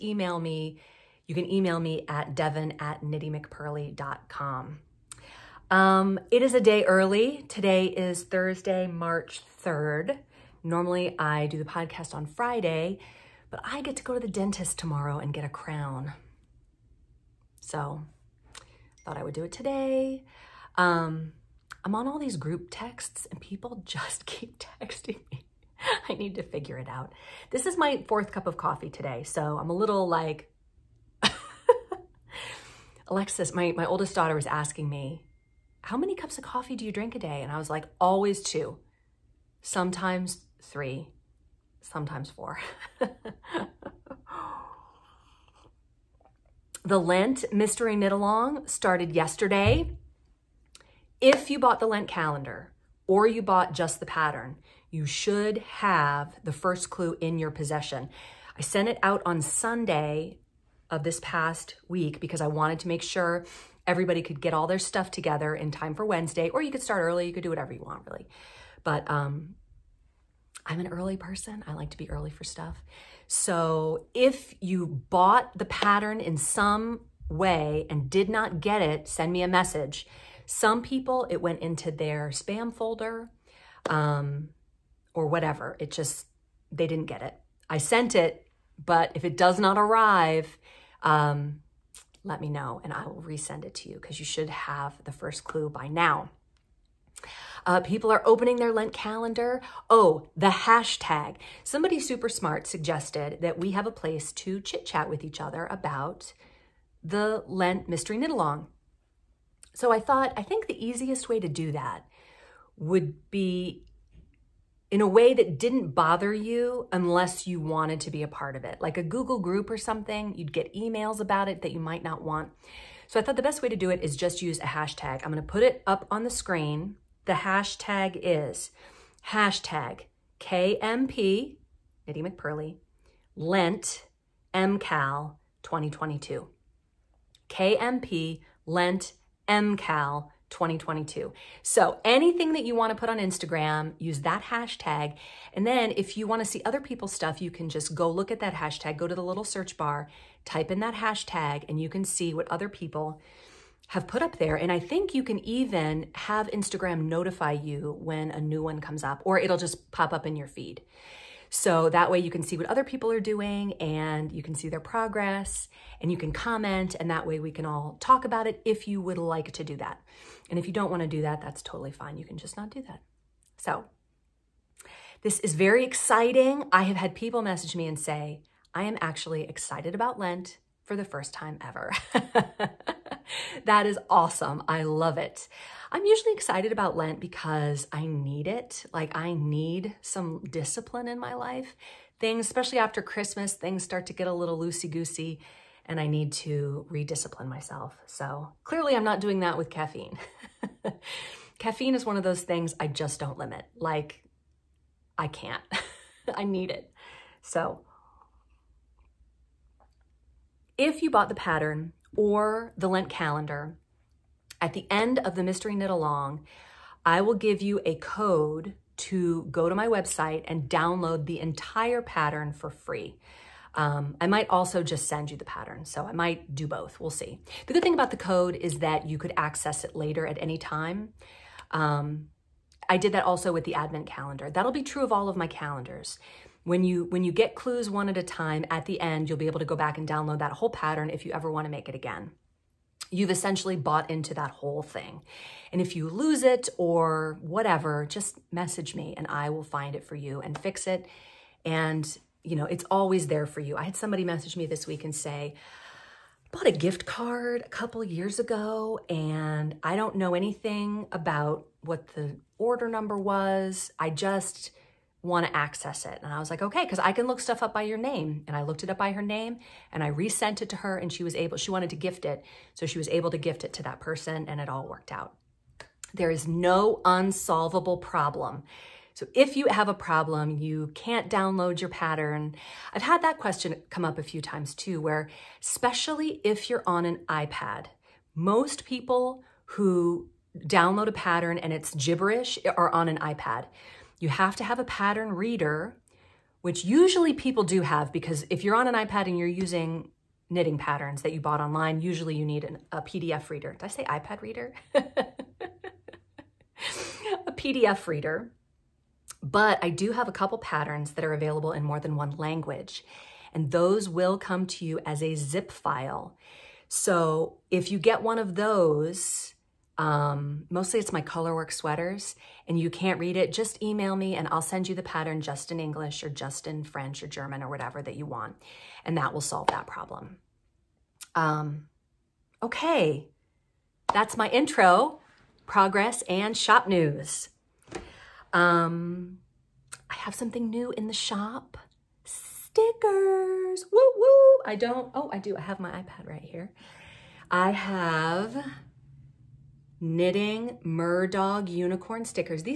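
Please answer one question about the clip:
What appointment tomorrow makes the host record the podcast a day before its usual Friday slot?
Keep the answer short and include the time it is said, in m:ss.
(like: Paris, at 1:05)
the dentist, at 0:14.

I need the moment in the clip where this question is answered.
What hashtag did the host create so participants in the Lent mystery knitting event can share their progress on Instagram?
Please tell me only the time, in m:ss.
2:17.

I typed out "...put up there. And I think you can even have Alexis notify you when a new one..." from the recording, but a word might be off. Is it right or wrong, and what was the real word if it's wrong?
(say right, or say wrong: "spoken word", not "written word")
wrong: "Instagram", not "Alexis".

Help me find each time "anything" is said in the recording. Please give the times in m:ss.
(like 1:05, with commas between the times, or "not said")
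2:22, 4:20.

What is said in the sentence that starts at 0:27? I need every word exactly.
This is my fourth cup of coffee today.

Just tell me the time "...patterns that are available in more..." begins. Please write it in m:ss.
5:10.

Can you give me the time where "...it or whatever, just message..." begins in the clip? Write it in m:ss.
4:06.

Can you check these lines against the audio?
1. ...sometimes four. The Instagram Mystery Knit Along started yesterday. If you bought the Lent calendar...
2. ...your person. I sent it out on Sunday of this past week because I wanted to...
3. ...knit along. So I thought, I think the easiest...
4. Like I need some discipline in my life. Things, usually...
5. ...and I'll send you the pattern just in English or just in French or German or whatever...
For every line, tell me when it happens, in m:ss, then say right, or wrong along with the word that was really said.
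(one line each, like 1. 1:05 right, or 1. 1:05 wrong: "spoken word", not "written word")
1. 0:41 wrong: "Lent", not "Instagram"
2. 0:57 wrong: "possession", not "person"
3. 1:48 right
4. 3:08 wrong: "especially", not "usually"
5. 5:24 right.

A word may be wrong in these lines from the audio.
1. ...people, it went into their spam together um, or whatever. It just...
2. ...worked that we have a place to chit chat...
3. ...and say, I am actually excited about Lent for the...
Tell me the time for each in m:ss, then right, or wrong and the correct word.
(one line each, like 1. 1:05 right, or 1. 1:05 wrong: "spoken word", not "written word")
1. 1:20 wrong: "folder", not "together"
2. 1:42 wrong: "suggested", not "worked"
3. 2:57 right.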